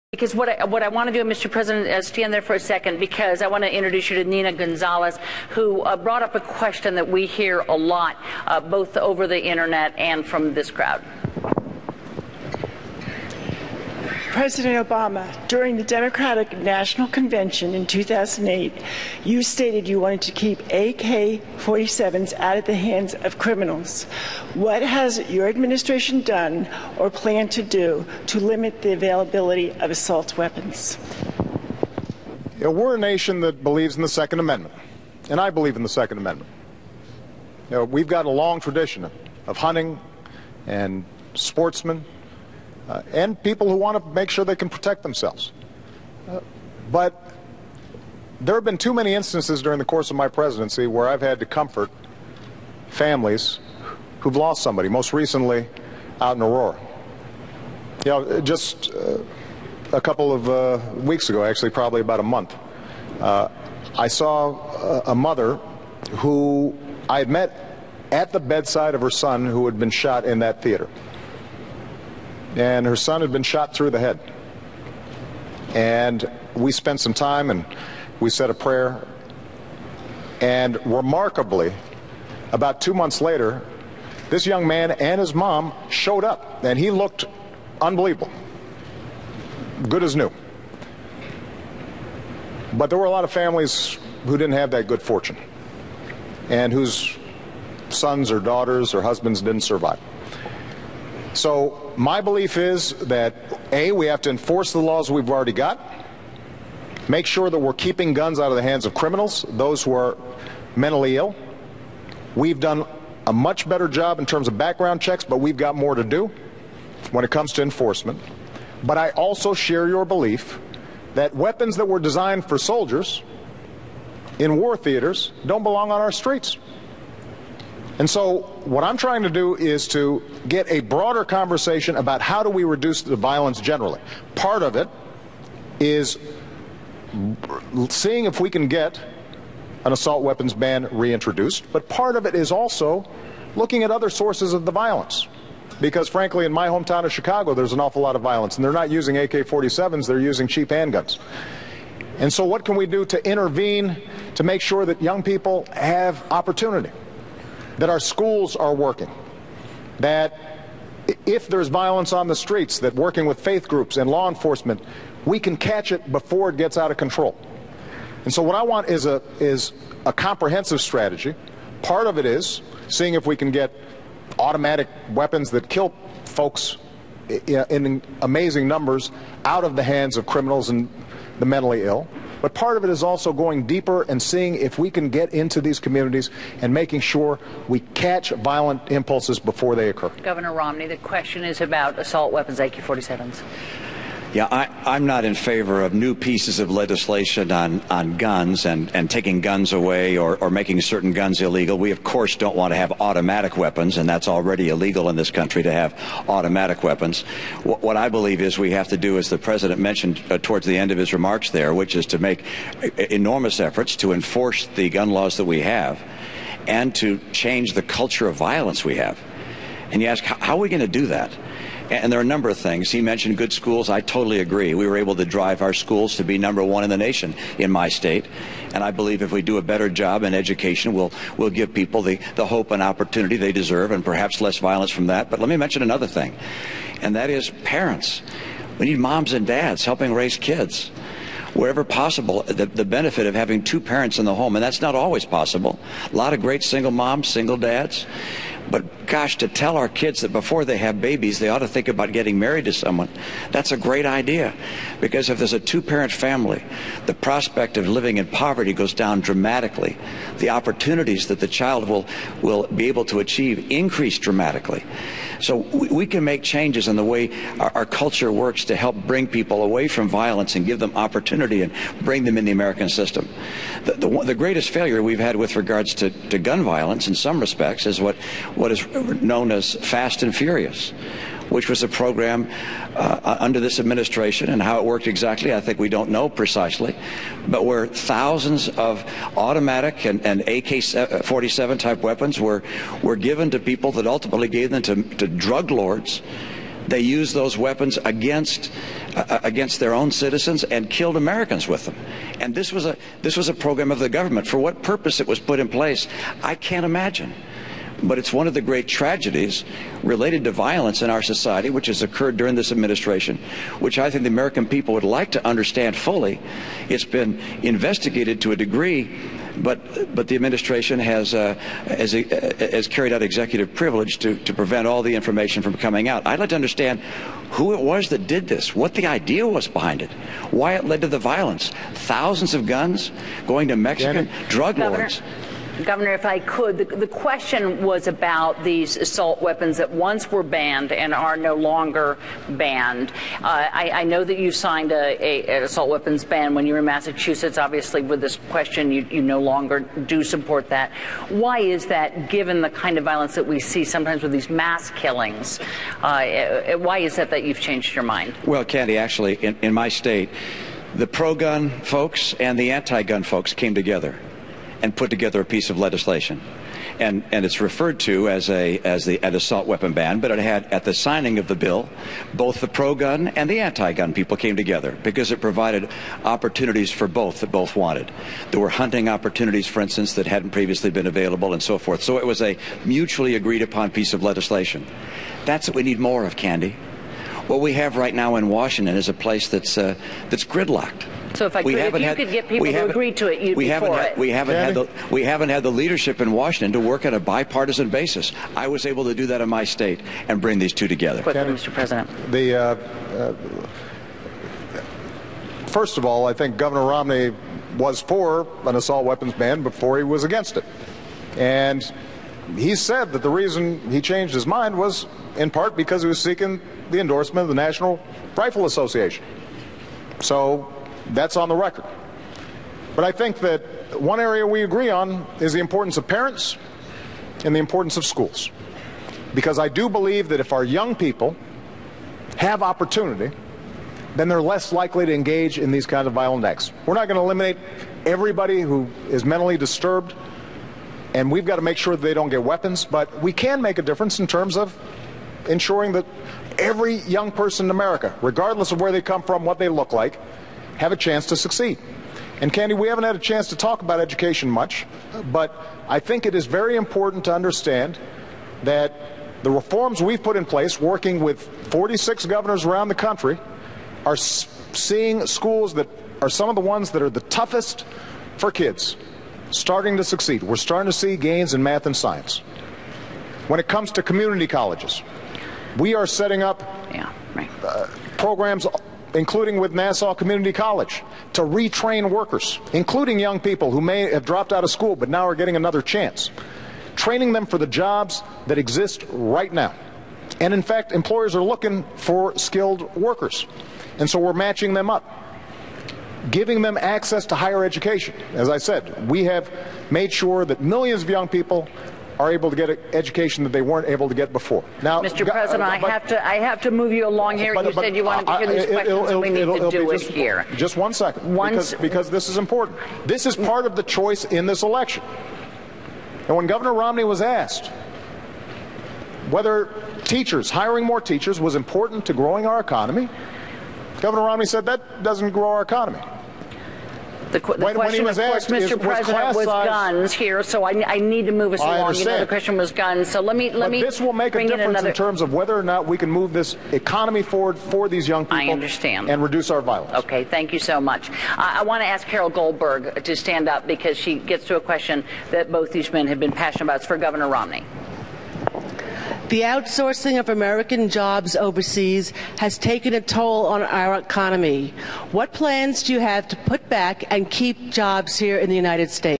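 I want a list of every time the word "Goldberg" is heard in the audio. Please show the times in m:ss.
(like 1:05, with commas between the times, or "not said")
9:02.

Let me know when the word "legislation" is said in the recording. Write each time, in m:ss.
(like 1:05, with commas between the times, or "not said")
3:16, 6:05, 6:24.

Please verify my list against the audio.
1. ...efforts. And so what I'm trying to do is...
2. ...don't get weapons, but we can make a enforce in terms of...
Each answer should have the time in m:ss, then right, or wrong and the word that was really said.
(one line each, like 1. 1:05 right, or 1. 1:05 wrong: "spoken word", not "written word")
1. 2:06 wrong: "streets", not "efforts"
2. 7:22 wrong: "difference", not "enforce".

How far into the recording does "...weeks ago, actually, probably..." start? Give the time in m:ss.
1:00.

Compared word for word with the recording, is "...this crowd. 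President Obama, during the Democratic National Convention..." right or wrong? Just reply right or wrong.
right.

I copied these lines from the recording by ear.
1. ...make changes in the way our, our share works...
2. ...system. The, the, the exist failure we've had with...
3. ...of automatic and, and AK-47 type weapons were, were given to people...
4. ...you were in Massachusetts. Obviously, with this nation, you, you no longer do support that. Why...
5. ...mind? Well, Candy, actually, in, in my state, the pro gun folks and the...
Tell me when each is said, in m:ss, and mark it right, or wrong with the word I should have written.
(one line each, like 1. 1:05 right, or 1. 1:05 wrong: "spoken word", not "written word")
1. 4:26 wrong: "culture", not "share"
2. 4:32 wrong: "greatest", not "exist"
3. 4:48 right
4. 5:46 wrong: "question", not "nation"
5. 5:58 right.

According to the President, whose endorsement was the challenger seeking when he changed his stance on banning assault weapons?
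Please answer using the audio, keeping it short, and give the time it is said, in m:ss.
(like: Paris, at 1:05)
National Rifle Association, at 6:57.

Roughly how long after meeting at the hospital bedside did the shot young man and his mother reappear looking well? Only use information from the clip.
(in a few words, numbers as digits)
about two months.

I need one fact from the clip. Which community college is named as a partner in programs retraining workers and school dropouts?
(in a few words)
Nassau Community College.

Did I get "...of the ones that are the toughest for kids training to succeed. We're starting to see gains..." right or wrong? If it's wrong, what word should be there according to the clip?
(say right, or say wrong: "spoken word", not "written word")
wrong: "starting", not "training".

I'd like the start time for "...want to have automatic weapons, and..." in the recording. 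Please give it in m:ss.
3:22.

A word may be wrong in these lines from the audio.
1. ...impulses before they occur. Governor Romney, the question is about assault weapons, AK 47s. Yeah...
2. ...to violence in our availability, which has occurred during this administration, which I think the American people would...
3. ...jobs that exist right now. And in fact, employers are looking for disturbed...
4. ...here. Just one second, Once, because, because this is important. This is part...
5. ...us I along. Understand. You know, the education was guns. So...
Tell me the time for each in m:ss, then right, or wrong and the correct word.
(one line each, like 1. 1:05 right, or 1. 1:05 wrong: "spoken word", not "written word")
1. 3:08 right
2. 5:10 wrong: "society", not "availability"
3. 8:07 wrong: "skilled", not "disturbed"
4. 8:30 right
5. 8:51 wrong: "question", not "education".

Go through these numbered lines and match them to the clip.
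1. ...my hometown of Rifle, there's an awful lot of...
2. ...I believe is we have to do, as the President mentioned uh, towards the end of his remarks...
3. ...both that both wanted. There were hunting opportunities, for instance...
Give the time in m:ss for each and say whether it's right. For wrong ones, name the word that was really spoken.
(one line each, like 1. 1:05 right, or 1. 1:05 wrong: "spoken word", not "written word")
1. 2:26 wrong: "Chicago", not "Rifle"
2. 3:27 right
3. 6:17 right.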